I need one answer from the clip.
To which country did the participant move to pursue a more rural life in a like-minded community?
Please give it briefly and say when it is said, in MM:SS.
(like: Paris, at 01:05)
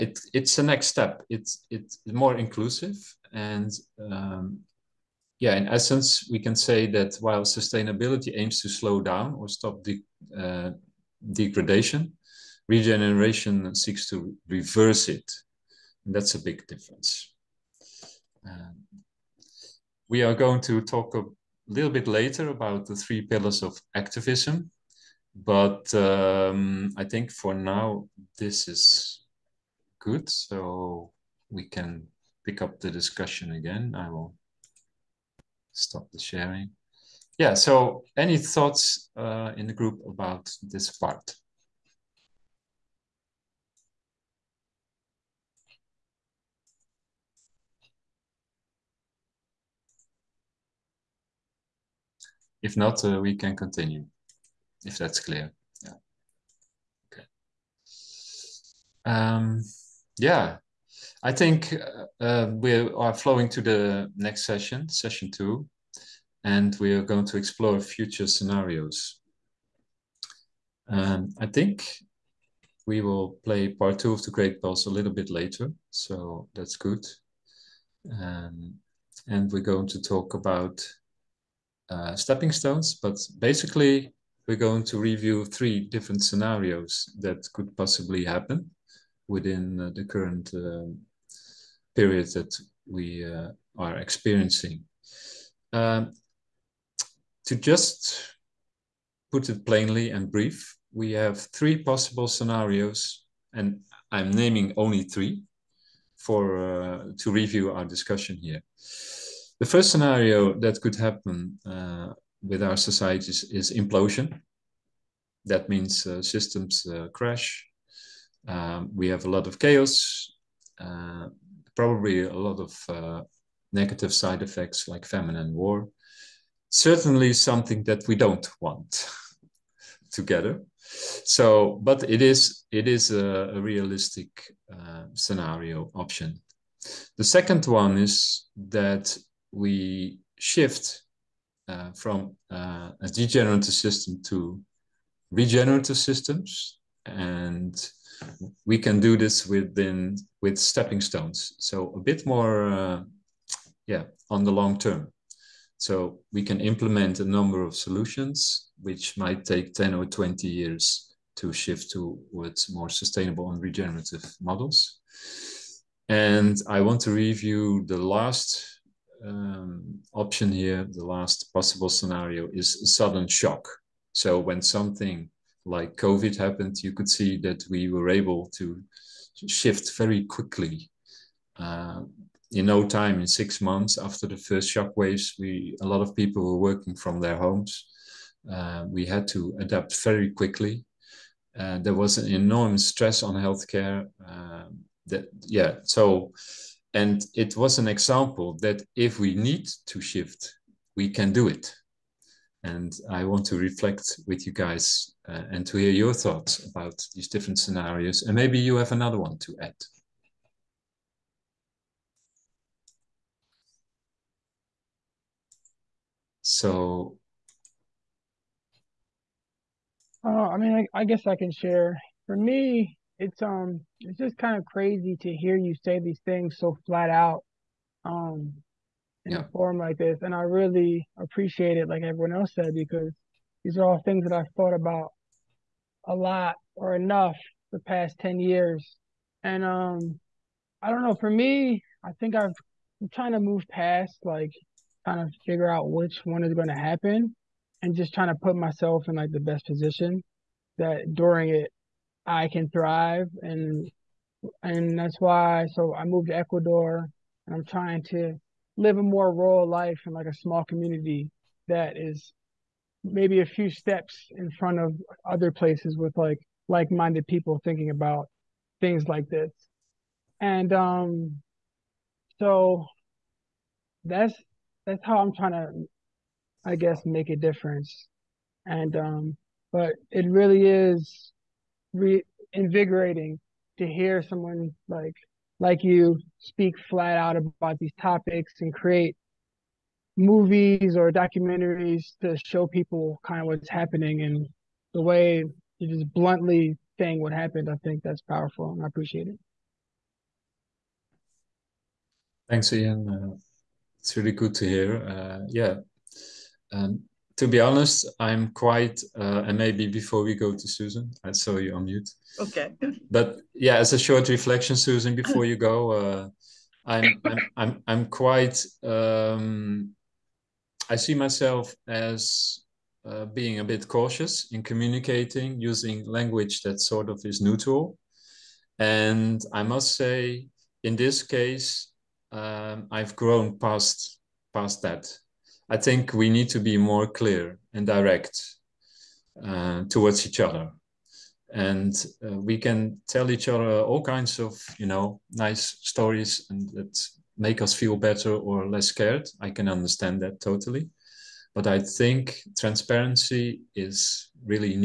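Ecuador, at 04:16.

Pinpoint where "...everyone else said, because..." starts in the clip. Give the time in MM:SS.
03:52.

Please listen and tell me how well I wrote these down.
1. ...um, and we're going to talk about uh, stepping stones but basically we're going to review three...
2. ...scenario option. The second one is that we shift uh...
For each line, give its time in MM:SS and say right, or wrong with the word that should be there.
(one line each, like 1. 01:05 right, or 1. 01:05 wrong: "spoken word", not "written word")
1. 01:18 right
2. 02:15 right.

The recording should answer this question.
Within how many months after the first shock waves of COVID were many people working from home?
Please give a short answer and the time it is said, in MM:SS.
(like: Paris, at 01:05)
6, at 03:03.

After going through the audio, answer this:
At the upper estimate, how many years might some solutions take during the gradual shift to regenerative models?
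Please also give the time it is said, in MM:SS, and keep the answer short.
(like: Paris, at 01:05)
20, at 02:40.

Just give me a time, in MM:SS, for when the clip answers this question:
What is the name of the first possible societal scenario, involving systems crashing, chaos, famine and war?
01:53.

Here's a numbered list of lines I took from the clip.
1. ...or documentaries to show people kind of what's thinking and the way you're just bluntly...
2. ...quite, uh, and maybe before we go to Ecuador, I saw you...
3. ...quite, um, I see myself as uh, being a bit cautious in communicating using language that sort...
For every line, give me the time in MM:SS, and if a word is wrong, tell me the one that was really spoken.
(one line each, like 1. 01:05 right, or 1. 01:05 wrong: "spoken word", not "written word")
1. 04:50 wrong: "happening", not "thinking"
2. 05:08 wrong: "Susan", not "Ecuador"
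3. 05:18 right.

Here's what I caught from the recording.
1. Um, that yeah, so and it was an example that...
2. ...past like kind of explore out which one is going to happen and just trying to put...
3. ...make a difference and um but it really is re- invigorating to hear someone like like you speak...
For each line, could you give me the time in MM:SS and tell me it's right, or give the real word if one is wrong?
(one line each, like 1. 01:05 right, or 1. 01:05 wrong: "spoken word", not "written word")
1. 03:14 right
2. 04:03 wrong: "figure", not "explore"
3. 04:37 right.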